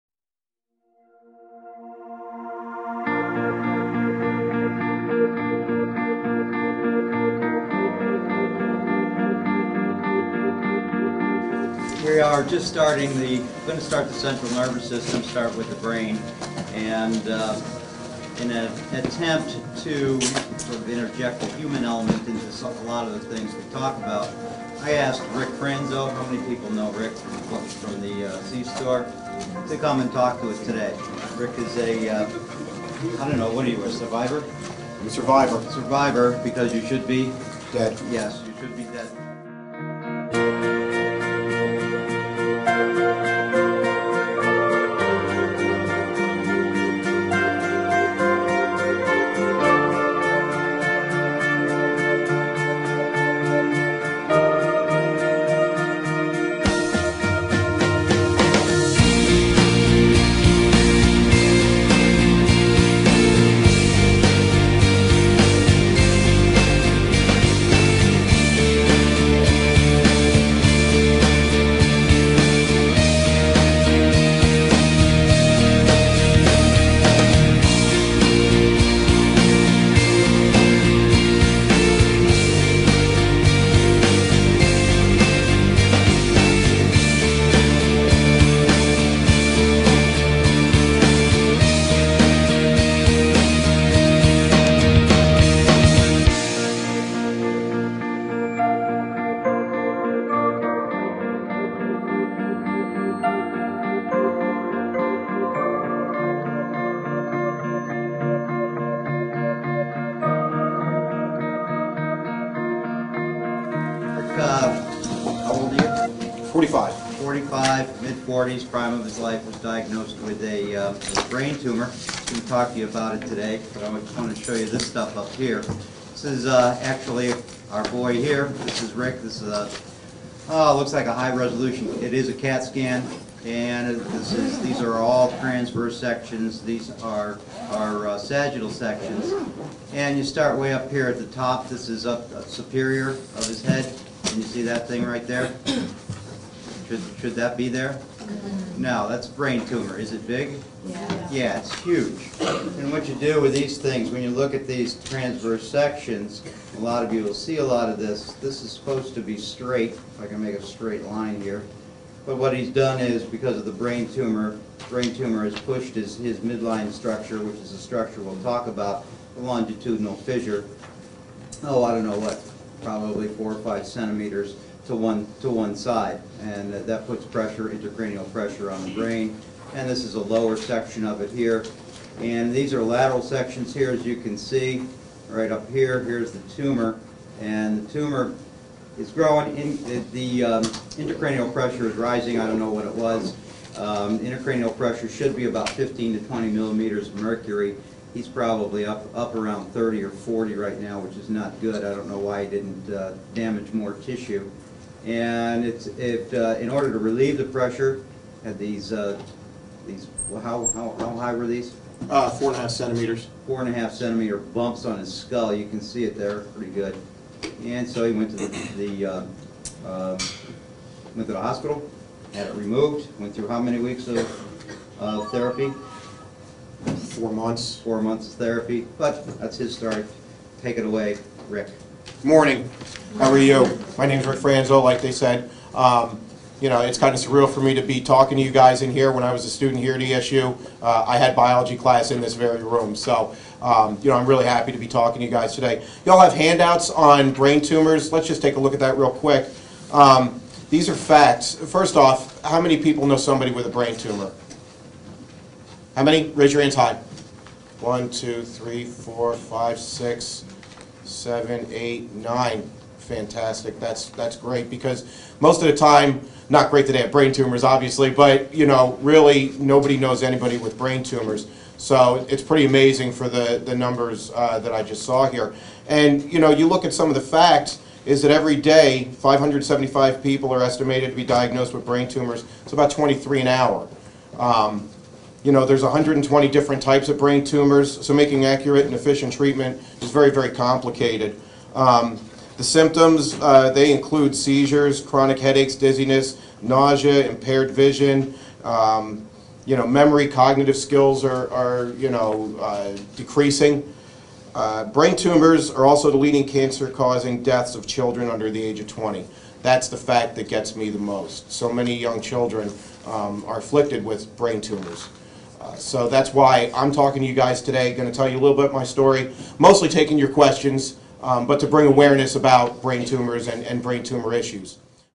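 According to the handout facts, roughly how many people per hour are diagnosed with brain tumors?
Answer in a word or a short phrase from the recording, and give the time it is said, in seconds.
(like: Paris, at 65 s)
23, at 282 s.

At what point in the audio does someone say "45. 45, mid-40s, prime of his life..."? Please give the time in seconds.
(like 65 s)
116 s.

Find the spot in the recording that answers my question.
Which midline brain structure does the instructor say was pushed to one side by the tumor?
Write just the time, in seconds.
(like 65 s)
169 s.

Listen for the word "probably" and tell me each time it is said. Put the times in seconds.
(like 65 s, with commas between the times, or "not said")
172 s, 198 s.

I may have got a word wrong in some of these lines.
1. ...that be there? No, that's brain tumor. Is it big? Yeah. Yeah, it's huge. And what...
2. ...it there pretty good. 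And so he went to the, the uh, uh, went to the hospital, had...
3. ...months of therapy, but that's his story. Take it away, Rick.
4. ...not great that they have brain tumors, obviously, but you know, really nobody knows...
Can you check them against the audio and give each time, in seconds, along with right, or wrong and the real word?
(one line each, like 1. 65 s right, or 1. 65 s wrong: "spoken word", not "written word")
1. 147 s right
2. 216 s right
3. 228 s right
4. 266 s right.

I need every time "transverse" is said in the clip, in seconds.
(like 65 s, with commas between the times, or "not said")
135 s, 155 s.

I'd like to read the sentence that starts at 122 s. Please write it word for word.
We am talk to you about it today, but I just want to show you this stuff up here.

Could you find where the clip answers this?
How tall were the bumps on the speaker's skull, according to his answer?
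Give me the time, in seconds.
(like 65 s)
212 s.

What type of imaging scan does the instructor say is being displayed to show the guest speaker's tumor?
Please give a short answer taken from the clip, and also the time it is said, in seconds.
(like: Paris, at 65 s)
CAT scan, at 132 s.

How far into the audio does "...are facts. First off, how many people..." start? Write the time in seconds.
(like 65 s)
250 s.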